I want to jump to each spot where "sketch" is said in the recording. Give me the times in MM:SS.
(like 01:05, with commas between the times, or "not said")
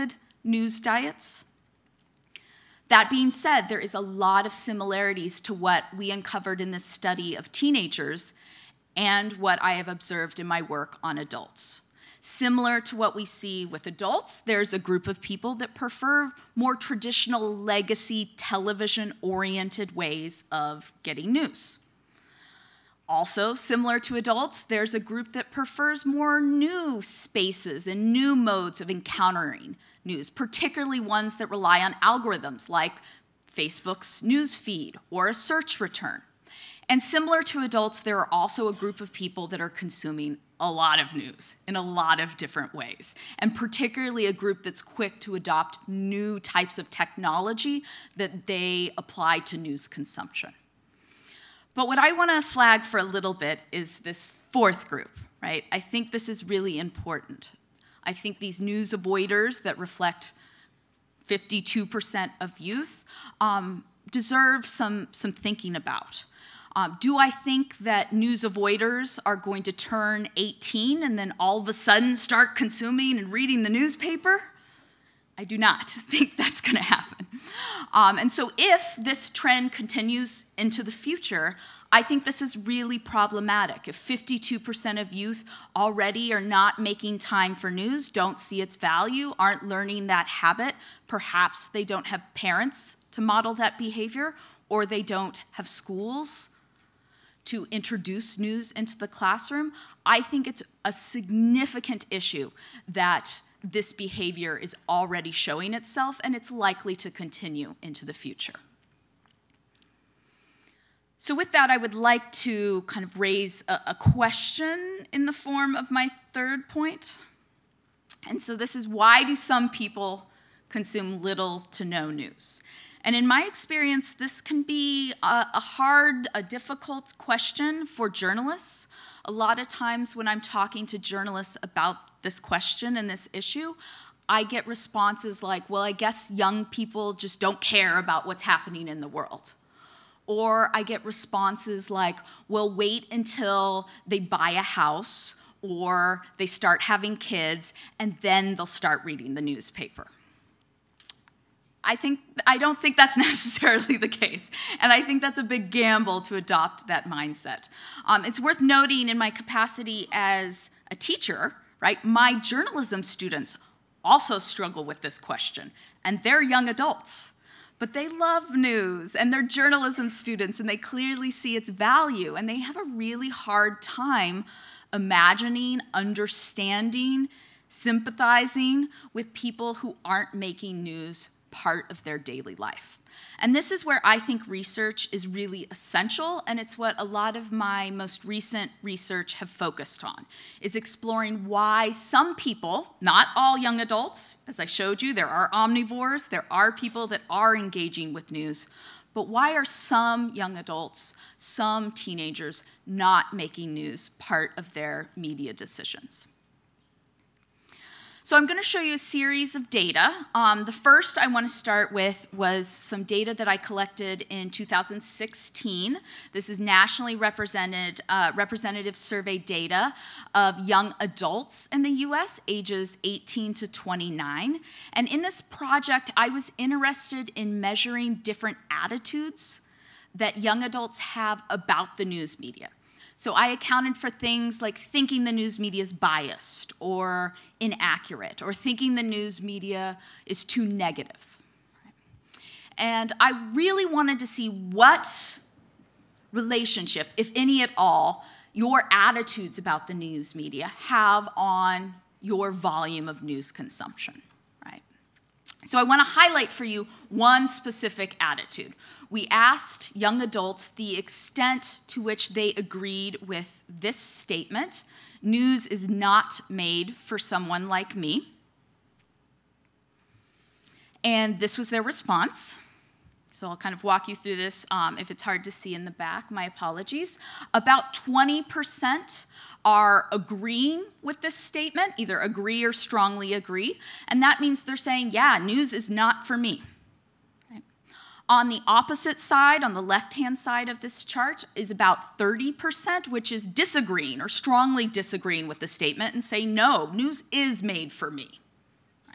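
not said.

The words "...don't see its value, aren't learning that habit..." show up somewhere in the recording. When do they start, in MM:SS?
01:28.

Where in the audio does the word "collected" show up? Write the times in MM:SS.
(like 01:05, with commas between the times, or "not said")
03:33.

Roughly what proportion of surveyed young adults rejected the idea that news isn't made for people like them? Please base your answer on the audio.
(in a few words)
30%.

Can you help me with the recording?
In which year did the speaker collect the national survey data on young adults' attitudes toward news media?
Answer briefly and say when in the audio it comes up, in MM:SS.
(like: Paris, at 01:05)
2016, at 03:34.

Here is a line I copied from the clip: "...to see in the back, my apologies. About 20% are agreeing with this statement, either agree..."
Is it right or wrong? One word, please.
right.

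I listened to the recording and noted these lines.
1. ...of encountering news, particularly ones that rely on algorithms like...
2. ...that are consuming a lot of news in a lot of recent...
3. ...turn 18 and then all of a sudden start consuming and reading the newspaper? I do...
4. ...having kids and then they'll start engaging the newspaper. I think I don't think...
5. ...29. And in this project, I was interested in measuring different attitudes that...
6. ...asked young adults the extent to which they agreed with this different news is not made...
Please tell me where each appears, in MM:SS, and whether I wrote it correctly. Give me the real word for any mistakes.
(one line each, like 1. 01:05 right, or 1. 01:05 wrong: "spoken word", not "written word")
1. 00:28 right
2. 00:39 wrong: "different", not "recent"
3. 01:09 right
4. 02:26 wrong: "reading", not "engaging"
5. 03:43 right
6. 04:19 wrong: "statement", not "different".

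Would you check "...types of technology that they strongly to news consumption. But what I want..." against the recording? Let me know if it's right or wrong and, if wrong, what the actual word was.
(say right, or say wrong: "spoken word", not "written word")
wrong: "apply", not "strongly".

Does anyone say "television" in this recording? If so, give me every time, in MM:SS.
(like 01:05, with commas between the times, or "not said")
00:18.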